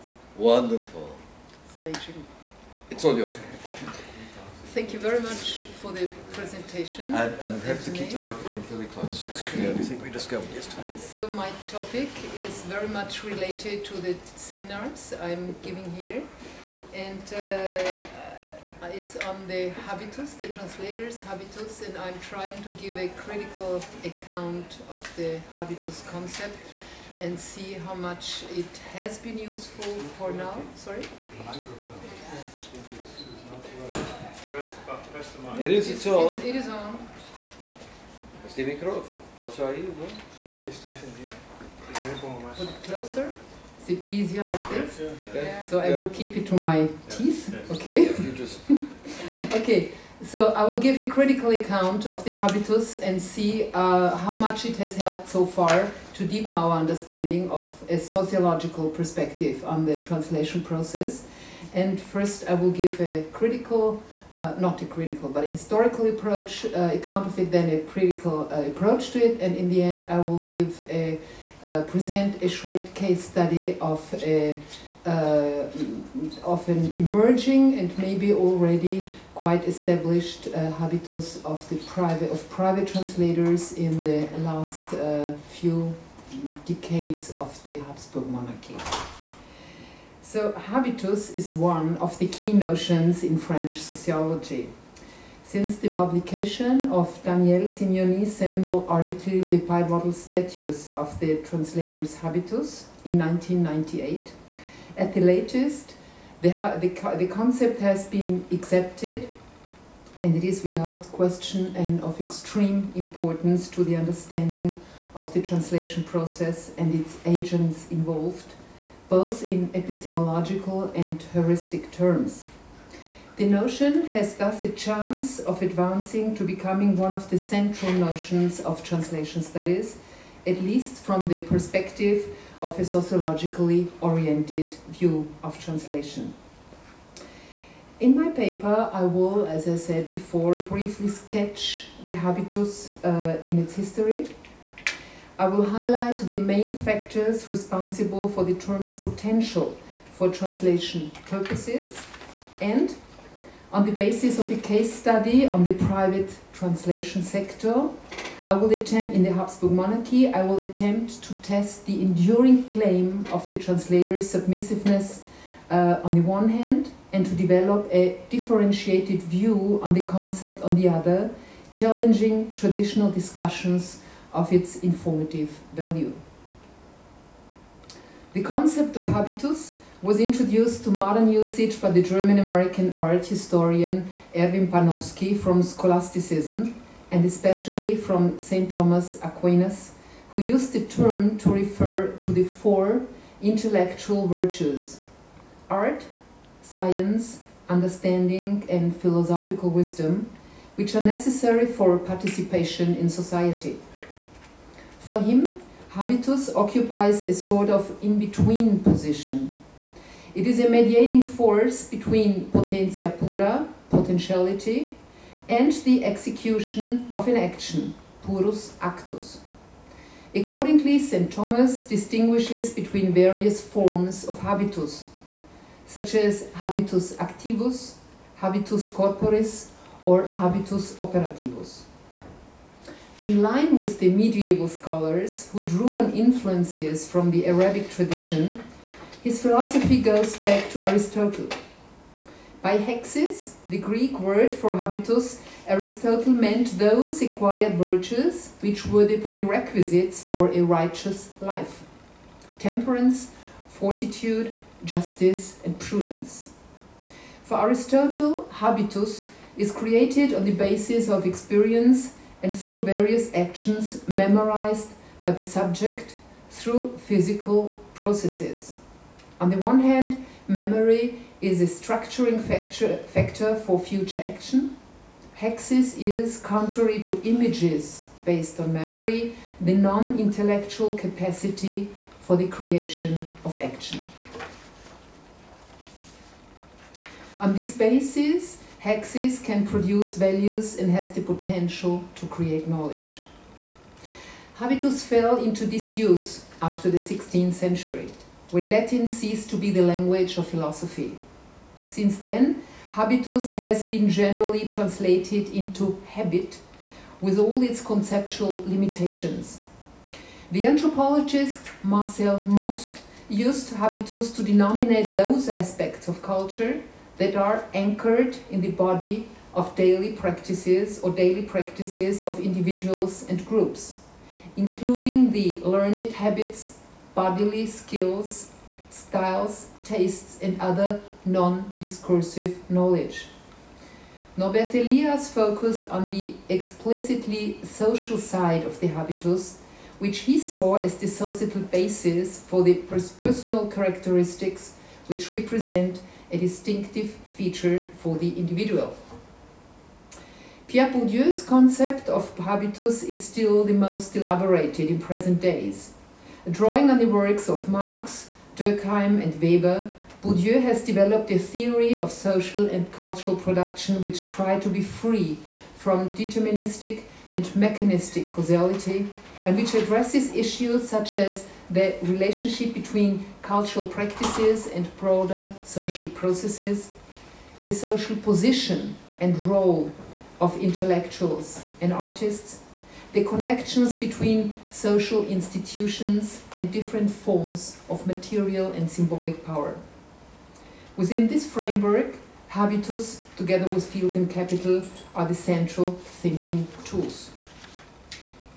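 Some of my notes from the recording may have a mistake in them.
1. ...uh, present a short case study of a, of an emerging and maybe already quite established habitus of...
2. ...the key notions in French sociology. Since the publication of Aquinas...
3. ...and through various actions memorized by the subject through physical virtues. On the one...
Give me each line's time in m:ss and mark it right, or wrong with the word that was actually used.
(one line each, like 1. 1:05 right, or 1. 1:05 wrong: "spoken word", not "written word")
1. 1:11 right
2. 1:32 wrong: "Daniel", not "Aquinas"
3. 4:22 wrong: "processes", not "virtues".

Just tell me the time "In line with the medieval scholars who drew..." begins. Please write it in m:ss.
3:53.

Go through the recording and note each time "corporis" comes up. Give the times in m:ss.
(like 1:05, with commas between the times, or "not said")
3:48.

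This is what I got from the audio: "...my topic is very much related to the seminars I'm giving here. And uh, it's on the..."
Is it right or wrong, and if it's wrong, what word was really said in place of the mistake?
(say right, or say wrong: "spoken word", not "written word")
right.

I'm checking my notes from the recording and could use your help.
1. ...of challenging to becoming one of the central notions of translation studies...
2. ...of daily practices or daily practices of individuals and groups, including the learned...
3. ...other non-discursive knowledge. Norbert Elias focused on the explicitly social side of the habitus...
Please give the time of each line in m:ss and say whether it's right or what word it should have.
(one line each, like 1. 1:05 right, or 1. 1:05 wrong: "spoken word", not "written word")
1. 2:05 wrong: "advancing", not "challenging"
2. 5:19 right
3. 5:30 right.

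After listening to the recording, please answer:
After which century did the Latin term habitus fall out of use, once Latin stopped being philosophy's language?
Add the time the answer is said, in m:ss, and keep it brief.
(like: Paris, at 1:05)
16th century, at 4:56.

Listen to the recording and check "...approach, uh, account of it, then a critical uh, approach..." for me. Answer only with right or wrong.
right.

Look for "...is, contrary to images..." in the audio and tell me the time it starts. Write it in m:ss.
4:35.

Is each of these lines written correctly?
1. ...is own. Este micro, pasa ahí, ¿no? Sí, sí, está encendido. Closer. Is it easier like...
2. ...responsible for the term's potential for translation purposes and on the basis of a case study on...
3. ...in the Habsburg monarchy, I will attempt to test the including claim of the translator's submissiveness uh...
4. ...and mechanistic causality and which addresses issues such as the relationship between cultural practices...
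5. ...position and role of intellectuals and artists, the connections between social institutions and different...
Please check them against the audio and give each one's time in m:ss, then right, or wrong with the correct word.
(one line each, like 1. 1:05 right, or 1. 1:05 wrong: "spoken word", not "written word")
1. 0:36 right
2. 2:27 right
3. 2:39 wrong: "enduring", not "including"
4. 6:07 right
5. 6:18 right.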